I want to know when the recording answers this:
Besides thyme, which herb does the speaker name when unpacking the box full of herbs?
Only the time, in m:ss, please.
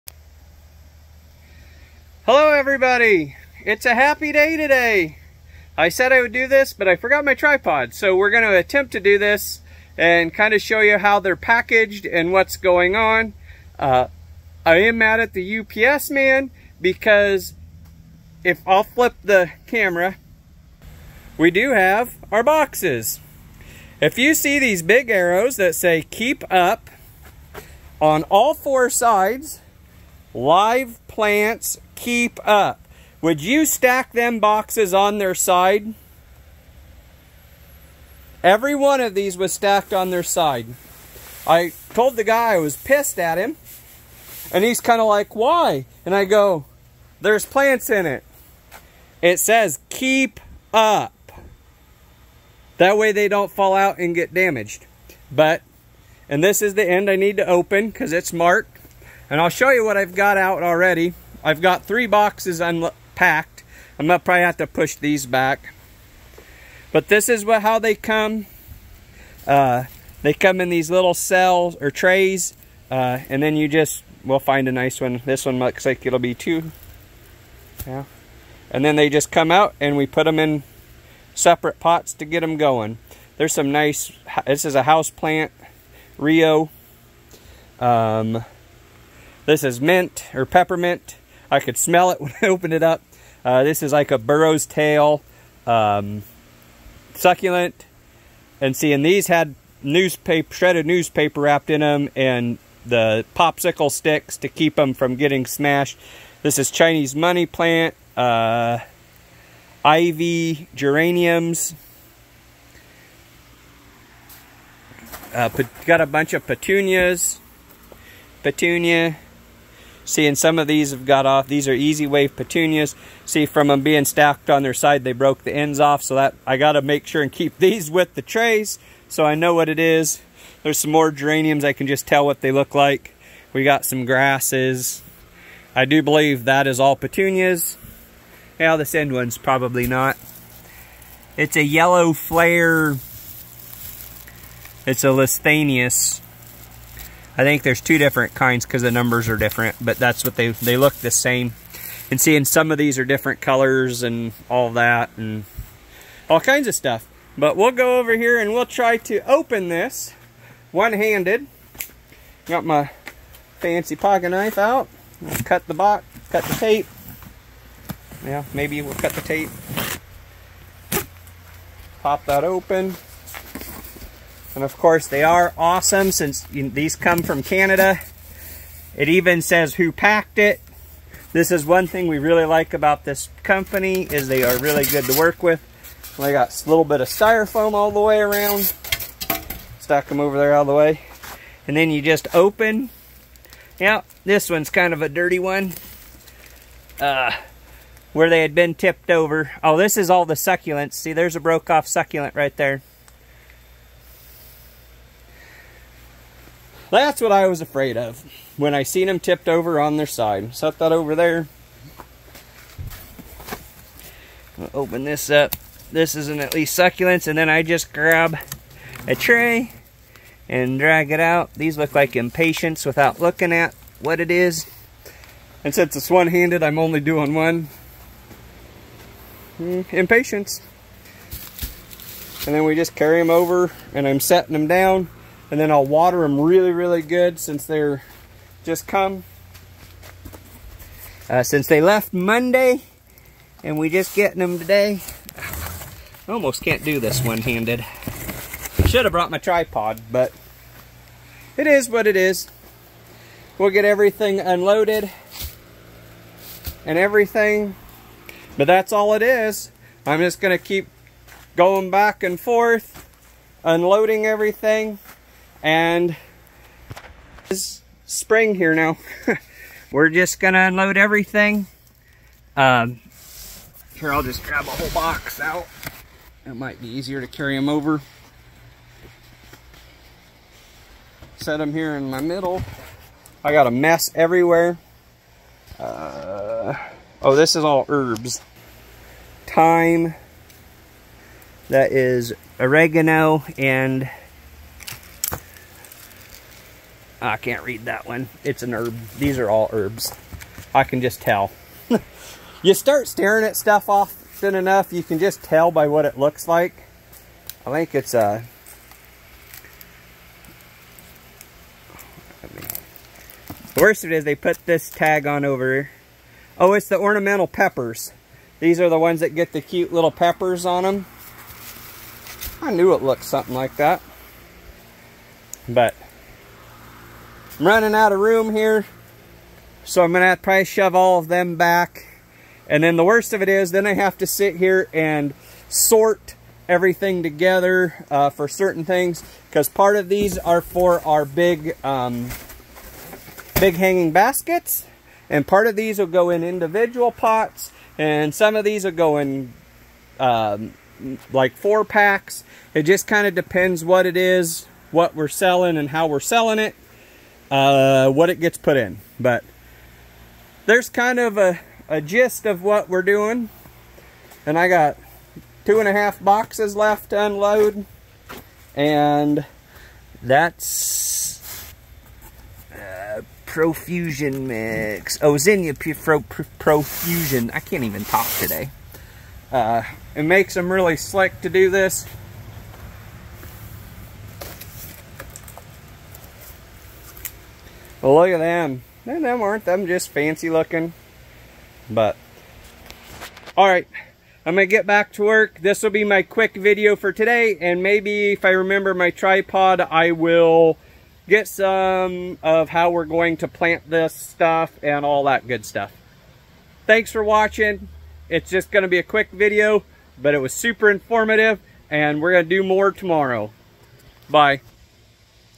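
4:52.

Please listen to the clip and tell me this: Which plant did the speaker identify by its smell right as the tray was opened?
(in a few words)
Mint.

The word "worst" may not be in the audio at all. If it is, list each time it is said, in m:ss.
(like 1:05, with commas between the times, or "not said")
5:13, 5:33.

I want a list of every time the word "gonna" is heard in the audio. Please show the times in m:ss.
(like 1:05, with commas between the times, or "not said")
1:04, 4:30.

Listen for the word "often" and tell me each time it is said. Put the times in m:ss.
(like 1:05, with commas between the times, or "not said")
5:03.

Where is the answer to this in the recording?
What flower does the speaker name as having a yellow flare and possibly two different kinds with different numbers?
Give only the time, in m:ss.
2:25.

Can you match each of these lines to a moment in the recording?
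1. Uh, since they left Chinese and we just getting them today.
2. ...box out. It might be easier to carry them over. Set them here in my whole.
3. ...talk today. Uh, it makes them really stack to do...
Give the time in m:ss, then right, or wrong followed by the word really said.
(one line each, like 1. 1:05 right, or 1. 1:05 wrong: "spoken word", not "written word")
1. 4:01 wrong: "Monday", not "Chinese"
2. 4:34 wrong: "middle", not "whole"
3. 6:18 wrong: "slick", not "stack".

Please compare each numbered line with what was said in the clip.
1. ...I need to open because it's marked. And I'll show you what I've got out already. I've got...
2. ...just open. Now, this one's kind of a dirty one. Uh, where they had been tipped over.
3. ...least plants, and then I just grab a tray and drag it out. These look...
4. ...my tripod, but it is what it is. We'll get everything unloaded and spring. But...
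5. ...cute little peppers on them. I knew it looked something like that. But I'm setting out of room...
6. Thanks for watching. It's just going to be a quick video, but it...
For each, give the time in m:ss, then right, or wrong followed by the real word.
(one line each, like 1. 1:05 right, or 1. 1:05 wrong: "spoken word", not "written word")
1. 0:57 right
2. 3:12 right
3. 3:36 wrong: "succulents", not "plants"
4. 4:09 wrong: "everything", not "spring"
5. 5:19 wrong: "running", not "setting"
6. 6:46 right.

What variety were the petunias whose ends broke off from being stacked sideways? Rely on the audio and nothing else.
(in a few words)
Easy wave.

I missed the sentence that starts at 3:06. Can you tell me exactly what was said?
They got a little bit of styrofoam all the way around.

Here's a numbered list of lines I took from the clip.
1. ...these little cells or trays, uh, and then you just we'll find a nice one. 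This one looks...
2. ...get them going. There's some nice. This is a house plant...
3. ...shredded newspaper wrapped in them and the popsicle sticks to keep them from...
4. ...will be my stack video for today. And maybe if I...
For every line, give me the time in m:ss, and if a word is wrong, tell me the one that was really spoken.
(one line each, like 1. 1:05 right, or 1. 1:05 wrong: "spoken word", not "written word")
1. 1:10 right
2. 1:22 right
3. 1:40 right
4. 6:35 wrong: "quick", not "stack".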